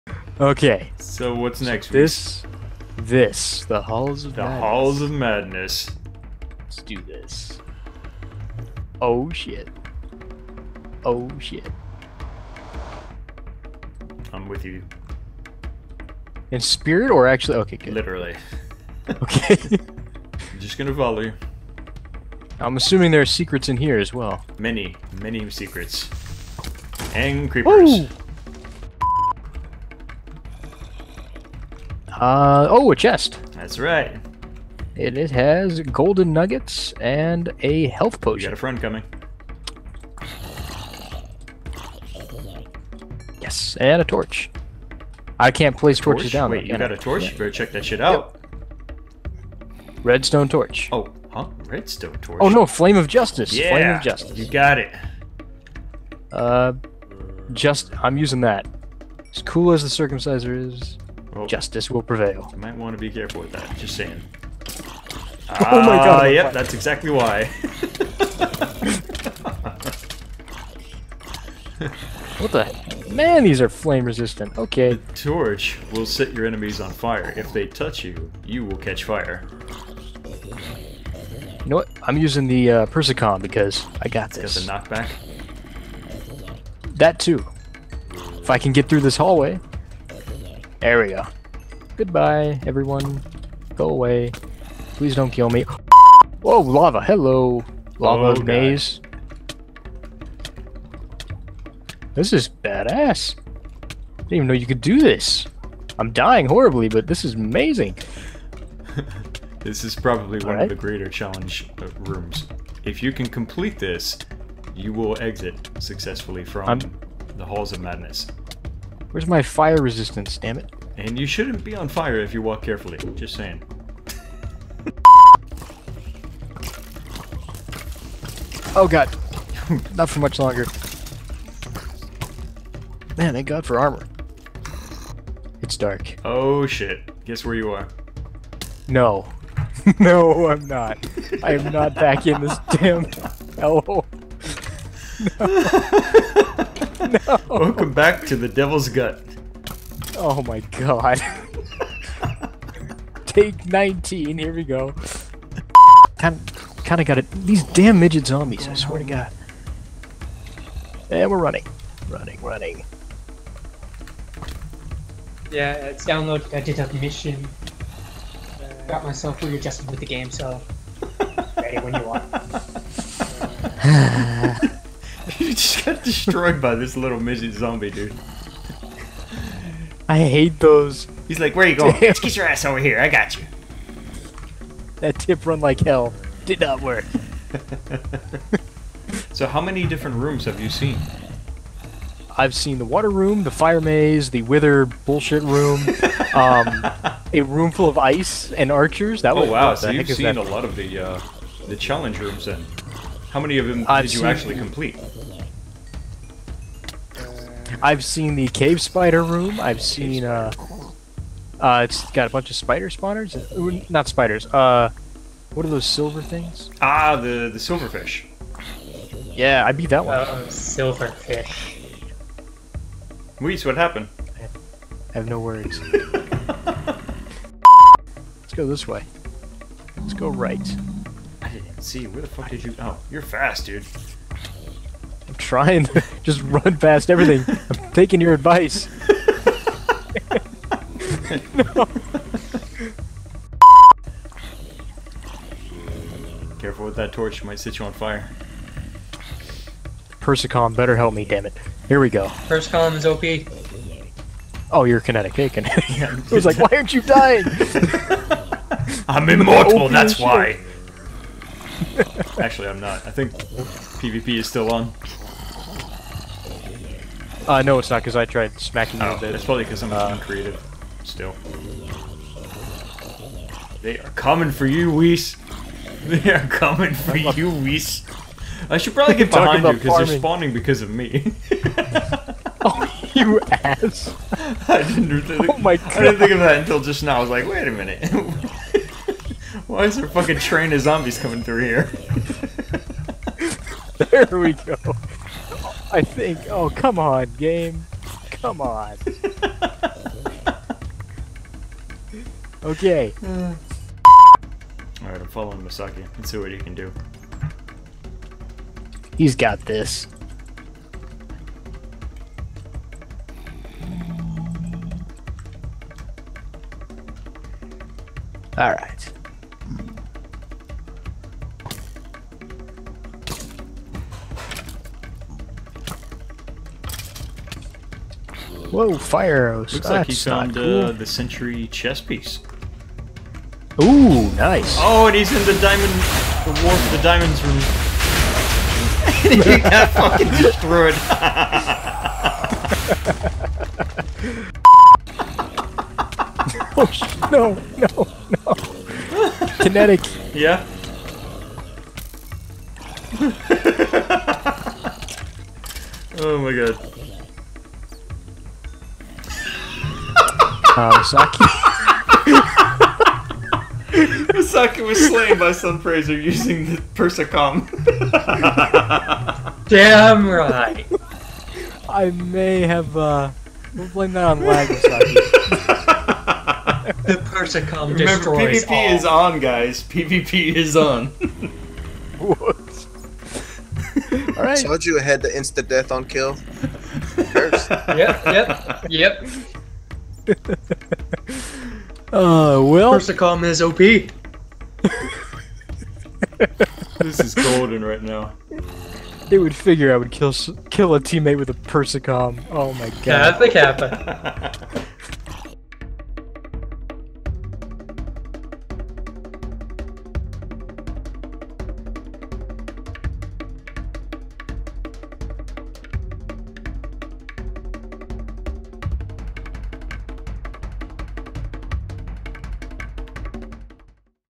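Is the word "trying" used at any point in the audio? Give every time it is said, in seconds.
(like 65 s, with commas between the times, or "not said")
235 s.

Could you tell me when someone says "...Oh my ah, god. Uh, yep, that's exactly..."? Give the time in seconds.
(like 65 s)
65 s.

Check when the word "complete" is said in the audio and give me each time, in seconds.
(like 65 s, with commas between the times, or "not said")
113 s, 204 s.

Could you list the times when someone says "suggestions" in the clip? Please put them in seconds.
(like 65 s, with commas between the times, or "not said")
not said.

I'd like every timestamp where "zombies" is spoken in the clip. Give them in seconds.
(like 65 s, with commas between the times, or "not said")
158 s, 177 s, 290 s.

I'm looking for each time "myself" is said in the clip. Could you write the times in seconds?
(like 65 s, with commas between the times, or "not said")
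169 s.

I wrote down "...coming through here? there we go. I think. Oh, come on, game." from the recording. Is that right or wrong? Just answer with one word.
right.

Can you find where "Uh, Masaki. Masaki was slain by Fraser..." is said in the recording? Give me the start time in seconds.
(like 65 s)
360 s.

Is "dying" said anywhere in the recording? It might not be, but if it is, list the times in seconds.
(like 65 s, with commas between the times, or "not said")
106 s, 257 s.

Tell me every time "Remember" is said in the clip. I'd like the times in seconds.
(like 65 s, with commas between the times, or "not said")
377 s.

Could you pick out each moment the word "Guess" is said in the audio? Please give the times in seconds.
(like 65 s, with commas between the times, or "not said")
137 s.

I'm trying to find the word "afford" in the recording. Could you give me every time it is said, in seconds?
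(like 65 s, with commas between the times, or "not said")
not said.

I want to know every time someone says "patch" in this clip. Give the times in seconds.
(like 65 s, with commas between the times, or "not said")
not said.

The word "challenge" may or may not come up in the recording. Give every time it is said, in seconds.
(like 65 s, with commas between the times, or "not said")
111 s, 201 s.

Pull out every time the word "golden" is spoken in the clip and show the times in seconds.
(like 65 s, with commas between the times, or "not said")
35 s, 397 s.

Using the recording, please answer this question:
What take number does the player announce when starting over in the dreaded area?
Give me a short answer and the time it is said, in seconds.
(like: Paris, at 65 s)
19, at 153 s.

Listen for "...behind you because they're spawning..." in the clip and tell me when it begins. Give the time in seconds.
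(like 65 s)
279 s.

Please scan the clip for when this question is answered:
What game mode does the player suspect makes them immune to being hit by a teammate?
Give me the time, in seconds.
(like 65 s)
270 s.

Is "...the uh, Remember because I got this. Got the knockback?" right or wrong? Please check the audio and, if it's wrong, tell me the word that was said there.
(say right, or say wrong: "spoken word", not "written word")
wrong: "Persicom", not "Remember".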